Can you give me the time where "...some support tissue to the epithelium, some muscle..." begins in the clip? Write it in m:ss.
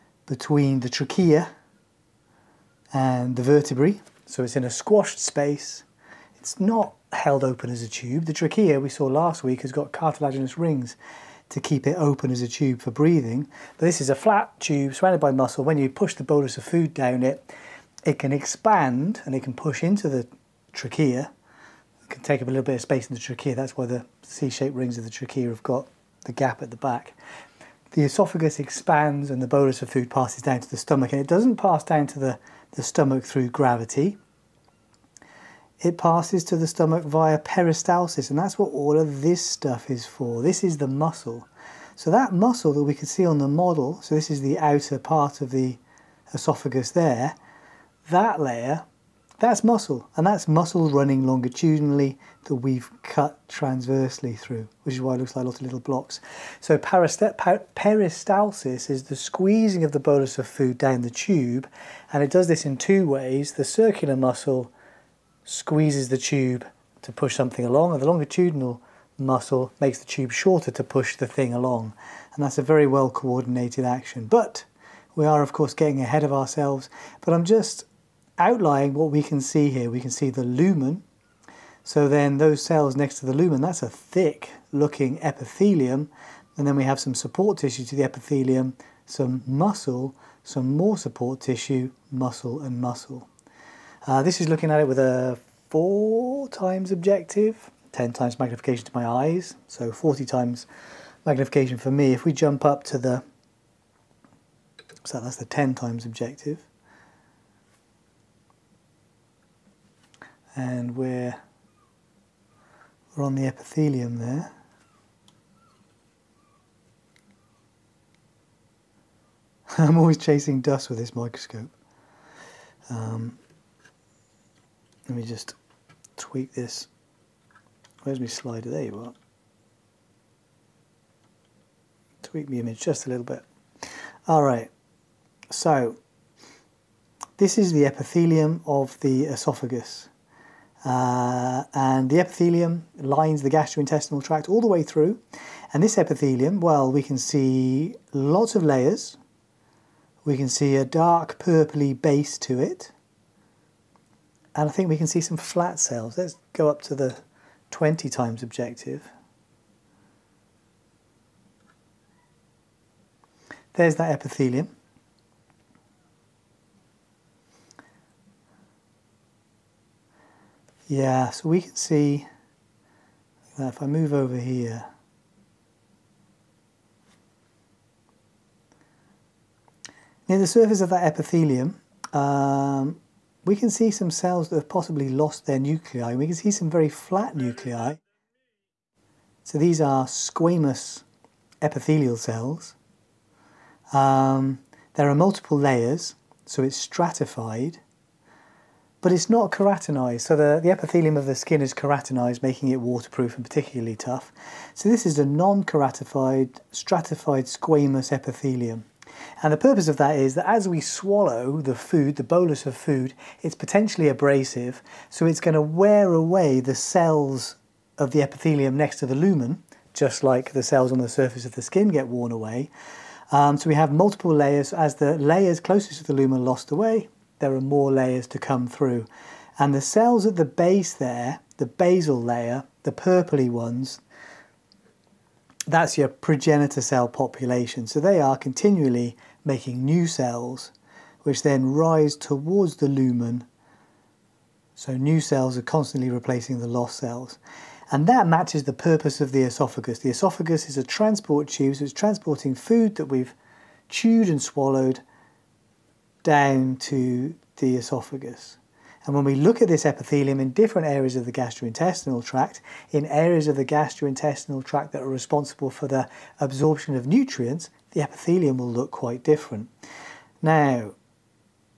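1:26.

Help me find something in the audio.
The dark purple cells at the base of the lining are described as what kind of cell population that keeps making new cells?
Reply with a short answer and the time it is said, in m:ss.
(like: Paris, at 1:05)
progenitor, at 3:56.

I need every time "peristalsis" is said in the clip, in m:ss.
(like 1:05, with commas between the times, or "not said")
0:37, 0:56.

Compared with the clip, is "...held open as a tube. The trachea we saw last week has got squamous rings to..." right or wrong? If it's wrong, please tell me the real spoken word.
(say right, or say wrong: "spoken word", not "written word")
wrong: "cartilaginous", not "squamous".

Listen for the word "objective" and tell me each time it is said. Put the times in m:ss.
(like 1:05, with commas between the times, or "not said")
1:36, 1:46, 2:38.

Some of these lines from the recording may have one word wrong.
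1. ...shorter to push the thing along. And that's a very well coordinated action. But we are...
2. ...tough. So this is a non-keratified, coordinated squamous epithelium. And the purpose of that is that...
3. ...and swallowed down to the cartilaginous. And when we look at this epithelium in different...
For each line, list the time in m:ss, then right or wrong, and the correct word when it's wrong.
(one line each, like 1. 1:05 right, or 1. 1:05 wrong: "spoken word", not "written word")
1. 1:10 right
2. 3:23 wrong: "stratified", not "coordinated"
3. 4:14 wrong: "esophagus", not "cartilaginous".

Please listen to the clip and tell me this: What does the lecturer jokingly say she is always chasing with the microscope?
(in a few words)
dust.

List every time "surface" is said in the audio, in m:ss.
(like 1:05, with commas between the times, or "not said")
3:00, 3:41.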